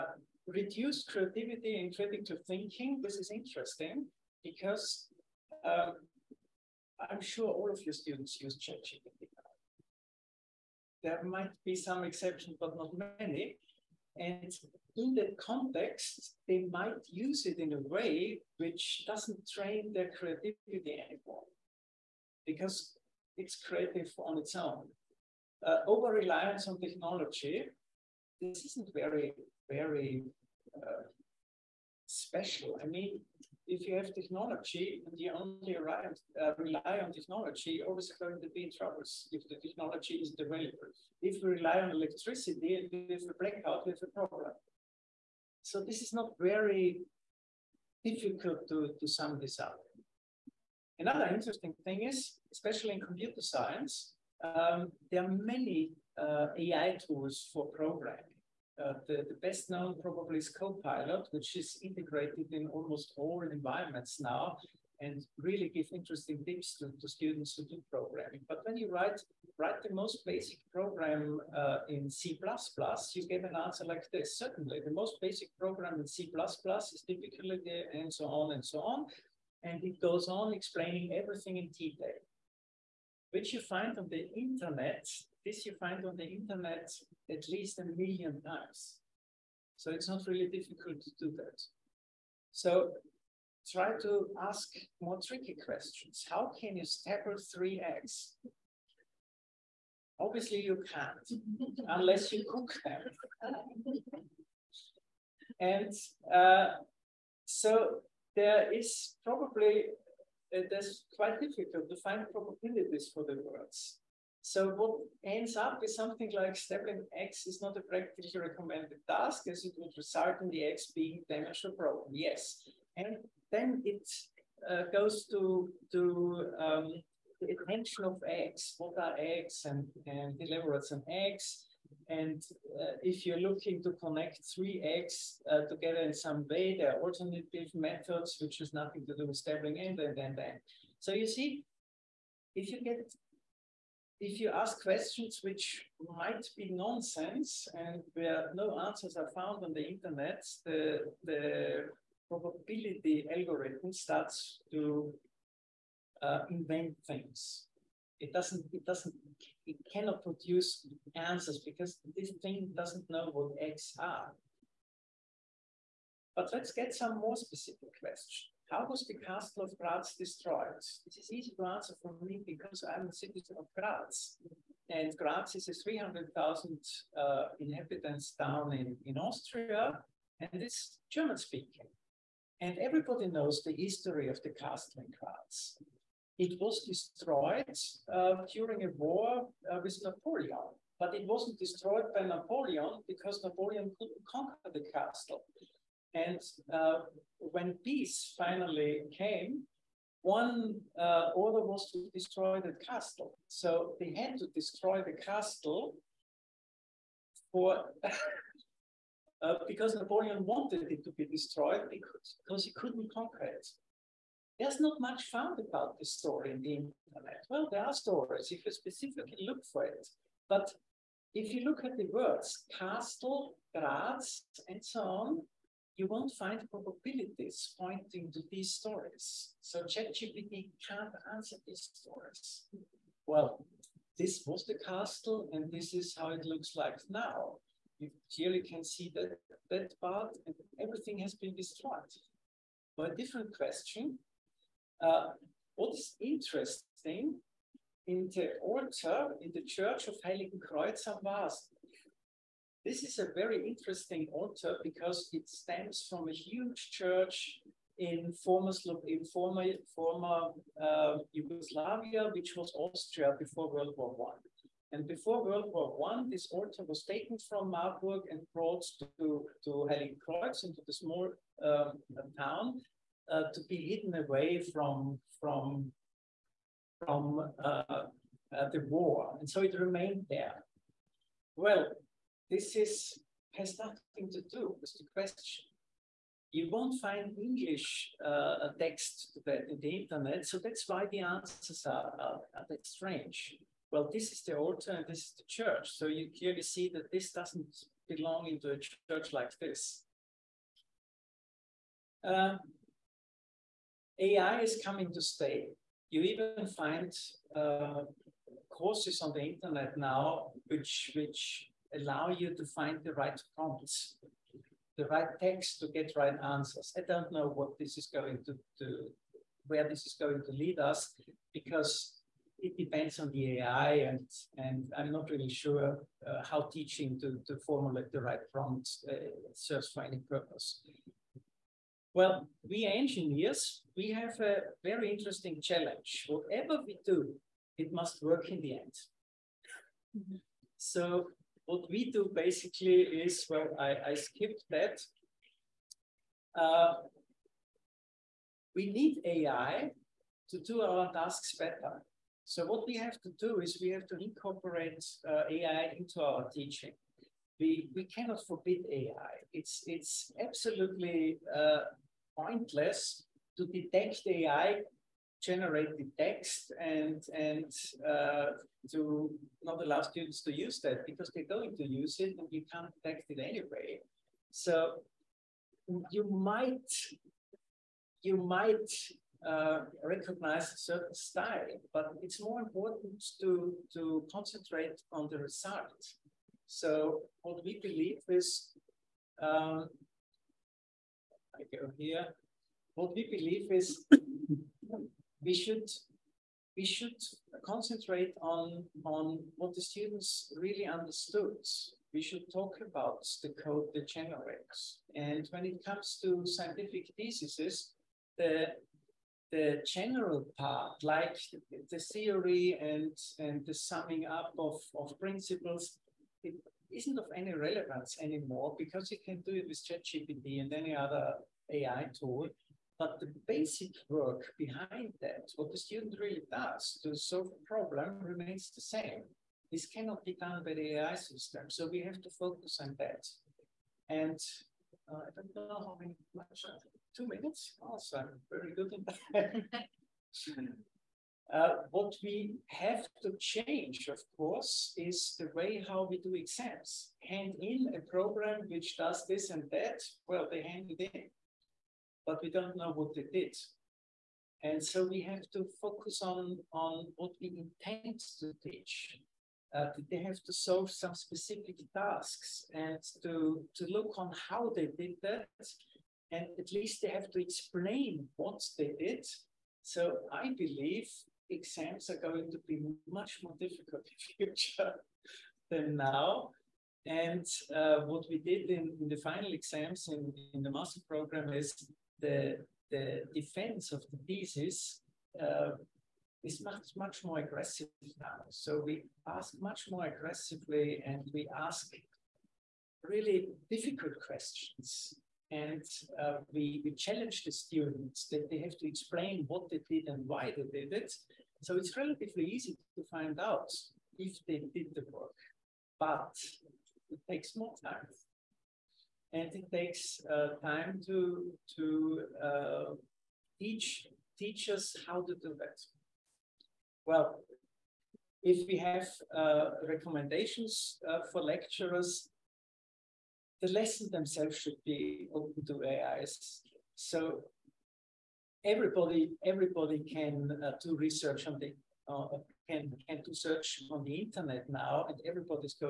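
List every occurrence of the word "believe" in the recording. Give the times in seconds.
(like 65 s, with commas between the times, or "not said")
387 s, 393 s, 470 s.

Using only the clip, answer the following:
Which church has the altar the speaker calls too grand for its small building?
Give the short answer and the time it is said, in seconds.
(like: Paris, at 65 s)
Heiligenkreuz am Waasen, at 250 s.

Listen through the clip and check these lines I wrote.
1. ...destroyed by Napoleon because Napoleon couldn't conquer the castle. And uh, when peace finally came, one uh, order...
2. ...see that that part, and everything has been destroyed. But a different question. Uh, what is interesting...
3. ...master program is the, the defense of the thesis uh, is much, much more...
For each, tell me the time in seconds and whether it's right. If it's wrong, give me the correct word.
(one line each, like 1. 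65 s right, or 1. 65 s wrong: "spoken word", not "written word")
1. 191 s right
2. 238 s right
3. 480 s right.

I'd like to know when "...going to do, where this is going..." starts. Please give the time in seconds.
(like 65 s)
318 s.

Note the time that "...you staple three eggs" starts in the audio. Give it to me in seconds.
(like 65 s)
96 s.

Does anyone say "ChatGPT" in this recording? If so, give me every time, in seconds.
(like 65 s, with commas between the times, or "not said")
8 s, 229 s, 419 s.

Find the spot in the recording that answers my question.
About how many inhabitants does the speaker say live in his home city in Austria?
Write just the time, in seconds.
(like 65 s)
175 s.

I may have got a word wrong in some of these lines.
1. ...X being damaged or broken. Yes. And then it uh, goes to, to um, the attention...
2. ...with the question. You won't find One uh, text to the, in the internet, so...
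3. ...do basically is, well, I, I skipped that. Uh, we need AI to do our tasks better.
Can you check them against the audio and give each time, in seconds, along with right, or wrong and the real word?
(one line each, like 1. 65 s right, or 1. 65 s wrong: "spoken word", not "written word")
1. 120 s right
2. 284 s wrong: "English", not "One"
3. 342 s right.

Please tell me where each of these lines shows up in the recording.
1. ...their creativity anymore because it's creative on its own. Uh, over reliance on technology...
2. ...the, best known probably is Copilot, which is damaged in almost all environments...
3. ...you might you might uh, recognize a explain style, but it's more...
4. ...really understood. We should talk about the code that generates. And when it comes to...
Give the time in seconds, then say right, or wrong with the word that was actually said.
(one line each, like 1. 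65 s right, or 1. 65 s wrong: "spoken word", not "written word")
1. 19 s right
2. 59 s wrong: "integrated", not "damaged"
3. 376 s wrong: "certain", not "explain"
4. 400 s right.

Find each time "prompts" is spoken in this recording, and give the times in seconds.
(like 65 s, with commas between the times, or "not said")
313 s, 328 s.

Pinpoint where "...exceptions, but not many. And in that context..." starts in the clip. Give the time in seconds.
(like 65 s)
12 s.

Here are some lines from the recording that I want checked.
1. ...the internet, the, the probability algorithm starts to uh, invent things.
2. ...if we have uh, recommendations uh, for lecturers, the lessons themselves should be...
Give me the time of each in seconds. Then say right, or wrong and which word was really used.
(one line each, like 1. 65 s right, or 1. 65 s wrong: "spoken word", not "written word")
1. 149 s right
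2. 518 s right.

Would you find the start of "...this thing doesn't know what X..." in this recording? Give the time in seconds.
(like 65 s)
162 s.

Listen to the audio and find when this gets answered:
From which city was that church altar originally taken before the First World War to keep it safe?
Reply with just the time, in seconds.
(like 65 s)
267 s.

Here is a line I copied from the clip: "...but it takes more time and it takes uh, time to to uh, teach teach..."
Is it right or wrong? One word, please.
right.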